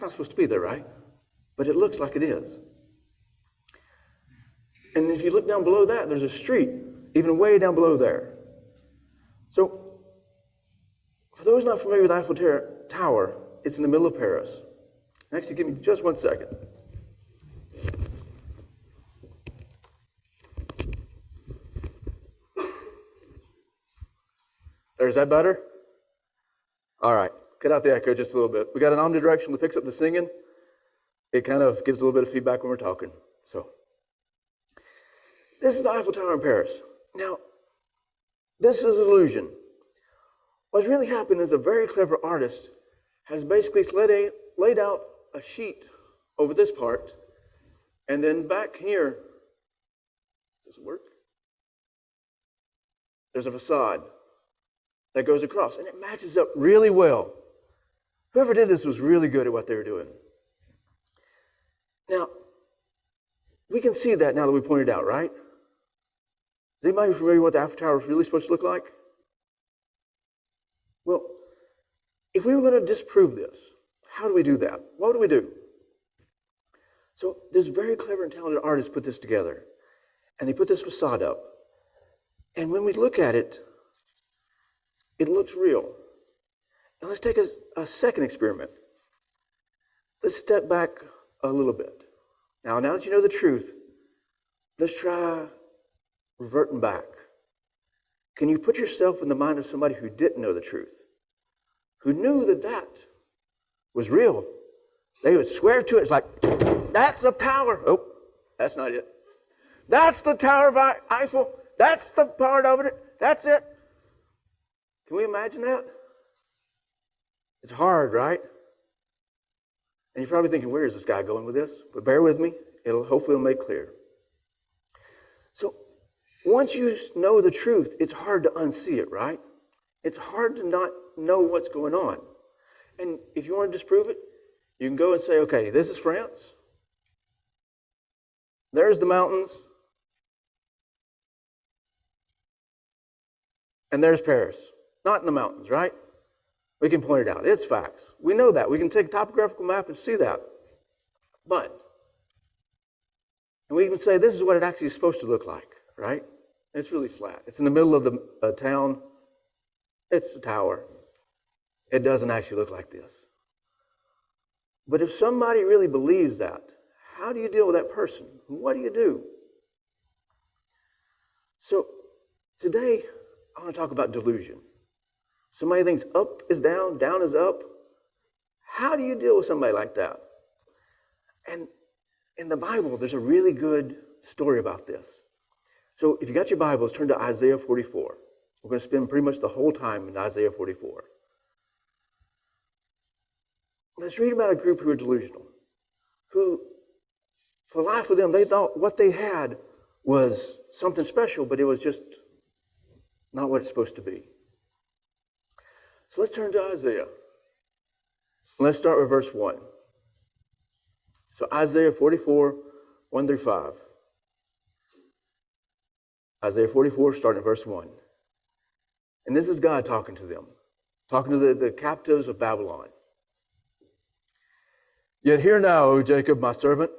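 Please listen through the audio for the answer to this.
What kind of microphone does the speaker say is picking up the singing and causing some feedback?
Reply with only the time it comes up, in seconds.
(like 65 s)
28 s.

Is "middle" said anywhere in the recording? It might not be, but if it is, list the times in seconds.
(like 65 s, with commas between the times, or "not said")
13 s, 157 s.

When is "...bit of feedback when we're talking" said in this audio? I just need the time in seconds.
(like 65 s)
32 s.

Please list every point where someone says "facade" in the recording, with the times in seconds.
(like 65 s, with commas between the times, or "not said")
53 s, 80 s.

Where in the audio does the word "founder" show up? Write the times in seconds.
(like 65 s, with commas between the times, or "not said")
not said.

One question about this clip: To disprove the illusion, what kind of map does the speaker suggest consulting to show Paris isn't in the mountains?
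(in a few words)
Topographical map.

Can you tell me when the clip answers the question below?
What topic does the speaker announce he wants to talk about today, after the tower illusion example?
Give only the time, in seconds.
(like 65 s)
174 s.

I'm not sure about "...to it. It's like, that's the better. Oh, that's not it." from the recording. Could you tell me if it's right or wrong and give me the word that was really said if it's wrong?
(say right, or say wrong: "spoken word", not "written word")
wrong: "power", not "better".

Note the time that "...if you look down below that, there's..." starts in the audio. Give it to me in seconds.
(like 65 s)
5 s.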